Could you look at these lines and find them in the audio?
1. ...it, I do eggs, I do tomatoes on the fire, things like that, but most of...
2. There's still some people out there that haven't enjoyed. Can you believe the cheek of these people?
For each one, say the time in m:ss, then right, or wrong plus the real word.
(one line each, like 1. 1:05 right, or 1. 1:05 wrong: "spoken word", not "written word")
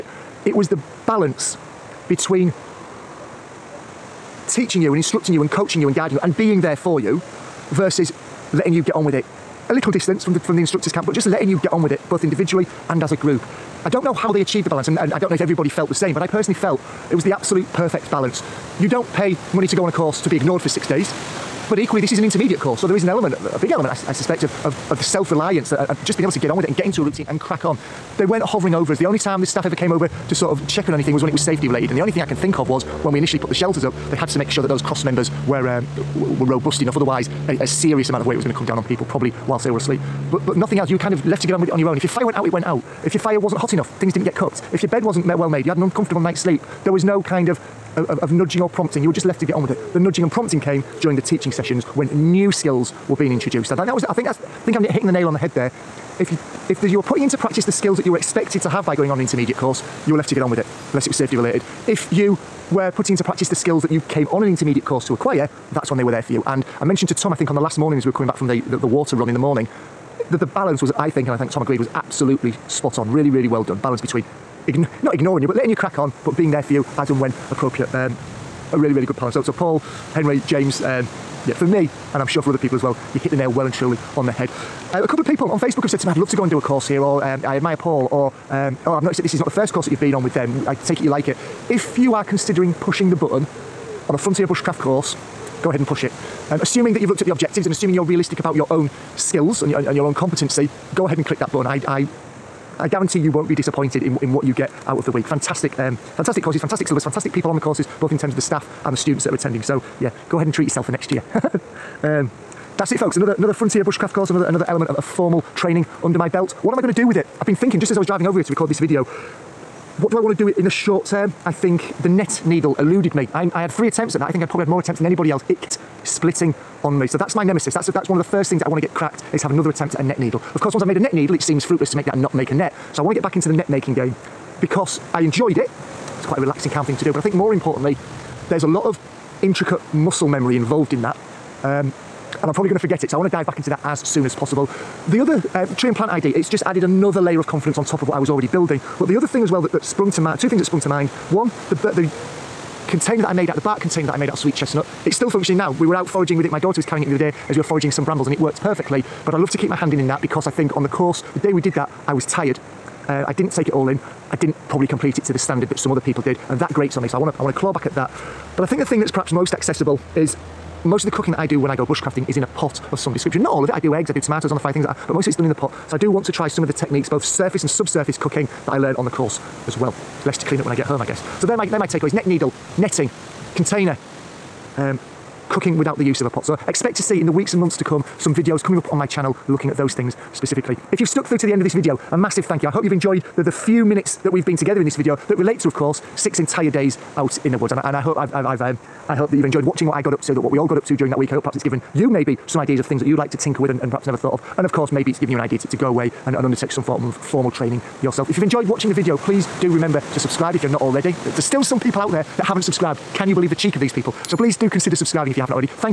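1. 2:53 right
2. 3:31 wrong: "subscribed", not "enjoyed".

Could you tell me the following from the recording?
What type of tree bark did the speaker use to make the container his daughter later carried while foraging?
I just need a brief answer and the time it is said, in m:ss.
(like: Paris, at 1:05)
Sweet chestnut, at 2:34.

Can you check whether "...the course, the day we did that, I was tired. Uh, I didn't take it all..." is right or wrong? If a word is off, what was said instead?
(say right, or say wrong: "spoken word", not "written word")
right.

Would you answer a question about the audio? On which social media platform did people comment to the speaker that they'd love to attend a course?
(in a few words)
Facebook.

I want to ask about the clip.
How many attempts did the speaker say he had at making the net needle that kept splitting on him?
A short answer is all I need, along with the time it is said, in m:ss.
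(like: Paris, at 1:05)
3, at 2:03.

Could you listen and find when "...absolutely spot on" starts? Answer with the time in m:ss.
1:11.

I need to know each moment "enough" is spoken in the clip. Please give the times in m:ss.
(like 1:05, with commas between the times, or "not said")
0:36, 0:43.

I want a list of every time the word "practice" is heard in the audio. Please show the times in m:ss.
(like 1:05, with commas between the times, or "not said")
0:57, 1:03.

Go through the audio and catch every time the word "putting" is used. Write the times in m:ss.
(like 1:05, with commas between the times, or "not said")
0:57, 1:02.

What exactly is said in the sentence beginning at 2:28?
But the other thing as well that, that sprung to mind, two things that sprung to mind.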